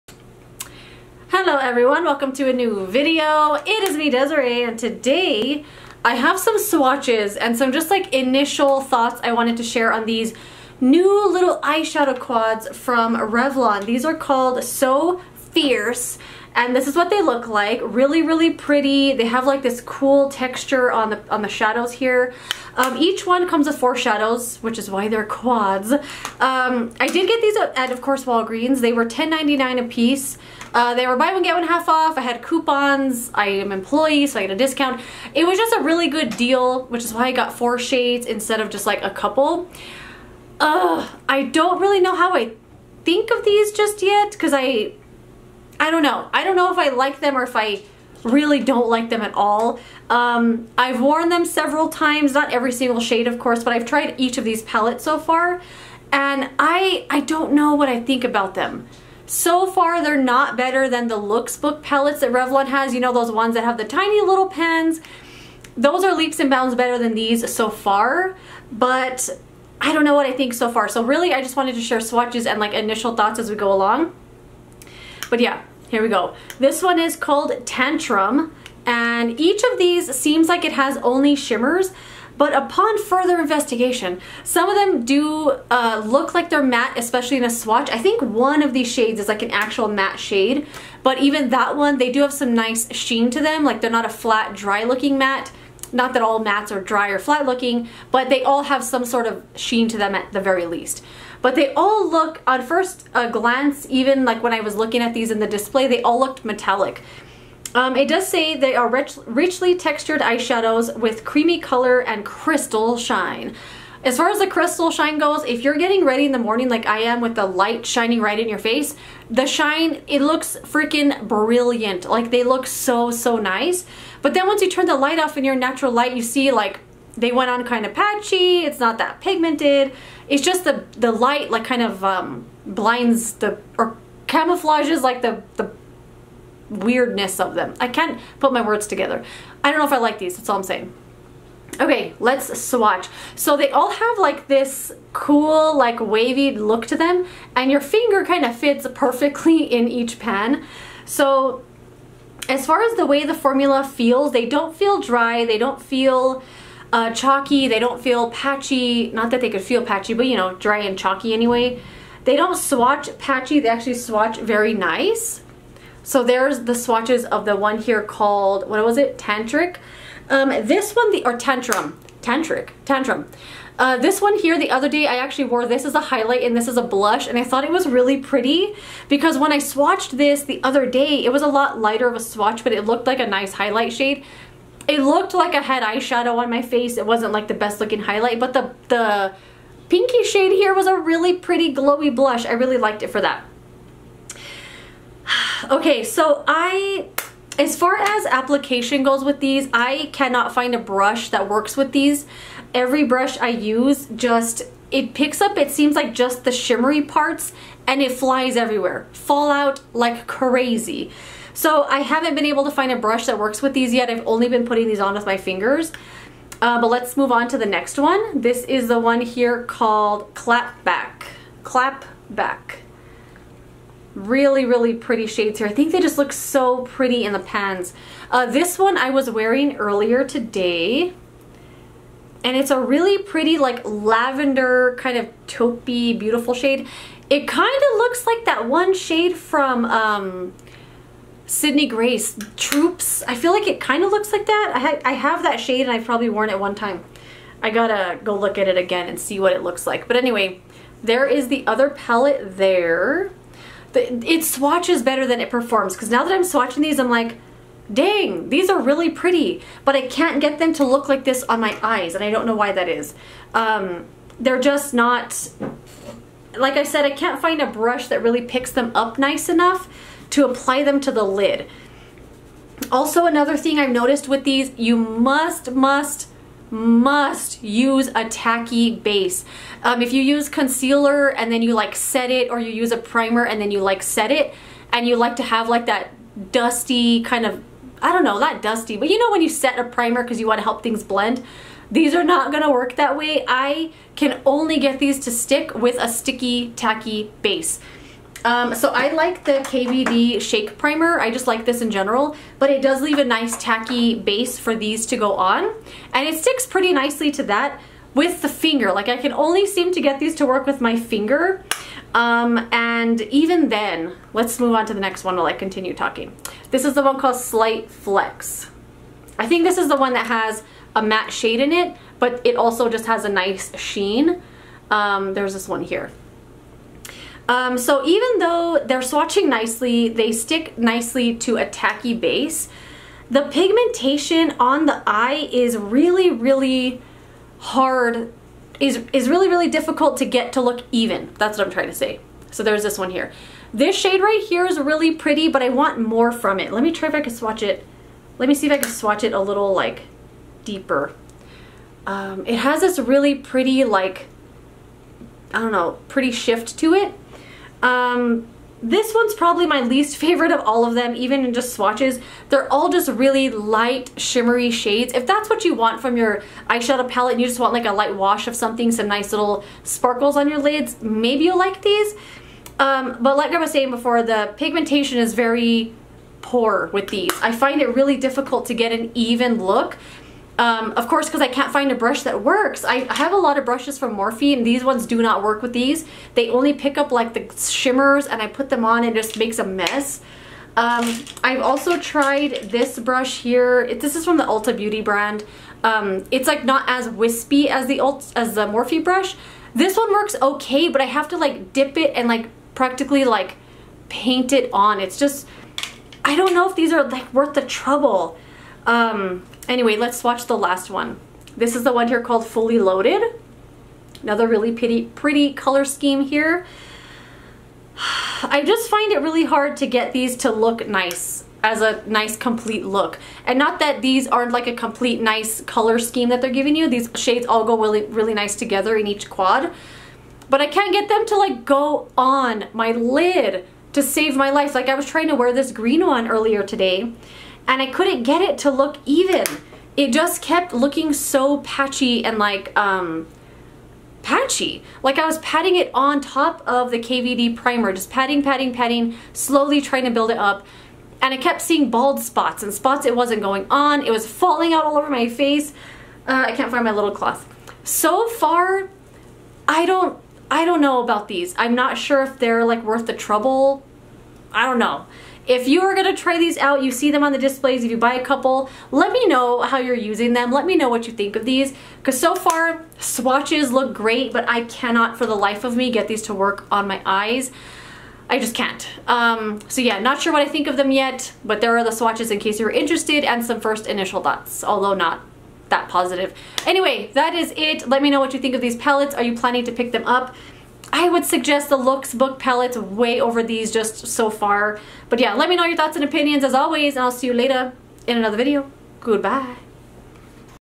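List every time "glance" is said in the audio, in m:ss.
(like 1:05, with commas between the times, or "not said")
1:43.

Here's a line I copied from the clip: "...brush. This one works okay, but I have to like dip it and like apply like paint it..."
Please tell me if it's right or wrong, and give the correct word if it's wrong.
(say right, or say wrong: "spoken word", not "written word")
wrong: "practically", not "apply".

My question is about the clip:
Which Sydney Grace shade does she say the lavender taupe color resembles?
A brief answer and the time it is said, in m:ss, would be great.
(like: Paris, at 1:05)
Troops, at 4:02.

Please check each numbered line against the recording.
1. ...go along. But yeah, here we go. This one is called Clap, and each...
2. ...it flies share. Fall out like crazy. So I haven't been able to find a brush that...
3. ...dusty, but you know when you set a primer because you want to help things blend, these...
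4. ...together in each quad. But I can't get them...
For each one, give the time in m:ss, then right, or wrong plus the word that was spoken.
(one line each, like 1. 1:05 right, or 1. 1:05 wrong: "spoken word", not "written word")
1. 1:13 wrong: "Tantrum", not "Clap"
2. 3:28 wrong: "everywhere", not "share"
3. 4:48 right
4. 7:08 right.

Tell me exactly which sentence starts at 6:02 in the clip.
They're all just really light, shimmery shades.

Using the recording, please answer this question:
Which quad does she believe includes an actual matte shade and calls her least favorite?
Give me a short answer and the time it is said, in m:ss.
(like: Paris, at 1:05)
Slight Flex, at 5:17.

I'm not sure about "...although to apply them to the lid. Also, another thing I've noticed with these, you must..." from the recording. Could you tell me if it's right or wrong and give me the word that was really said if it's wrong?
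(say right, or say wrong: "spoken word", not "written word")
wrong: "enough", not "although".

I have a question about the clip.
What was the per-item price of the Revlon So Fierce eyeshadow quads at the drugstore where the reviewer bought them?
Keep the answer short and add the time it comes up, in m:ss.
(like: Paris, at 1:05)
$10.99, at 0:29.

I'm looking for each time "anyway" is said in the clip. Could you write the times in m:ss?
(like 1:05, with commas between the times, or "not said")
2:41, 4:10, 6:49, 8:06.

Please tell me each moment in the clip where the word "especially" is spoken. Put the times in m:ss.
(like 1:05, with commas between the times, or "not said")
1:26.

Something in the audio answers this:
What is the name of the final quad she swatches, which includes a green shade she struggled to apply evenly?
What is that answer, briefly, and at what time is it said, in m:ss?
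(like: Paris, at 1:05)
Fully Loaded, at 6:52.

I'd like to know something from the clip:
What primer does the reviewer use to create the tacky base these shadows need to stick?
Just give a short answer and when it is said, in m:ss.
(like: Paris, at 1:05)
KVD Shake Primer, at 4:59.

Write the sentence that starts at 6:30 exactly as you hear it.
Um, I've also tried this brush here.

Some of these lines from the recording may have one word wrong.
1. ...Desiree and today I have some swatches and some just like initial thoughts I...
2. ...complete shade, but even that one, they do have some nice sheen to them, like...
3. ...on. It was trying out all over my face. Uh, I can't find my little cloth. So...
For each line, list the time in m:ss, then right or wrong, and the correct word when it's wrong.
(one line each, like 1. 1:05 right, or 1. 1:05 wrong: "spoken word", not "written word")
1. 0:04 right
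2. 1:29 wrong: "matte", not "complete"
3. 7:33 wrong: "falling", not "trying".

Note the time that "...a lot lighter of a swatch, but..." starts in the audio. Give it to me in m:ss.
3:01.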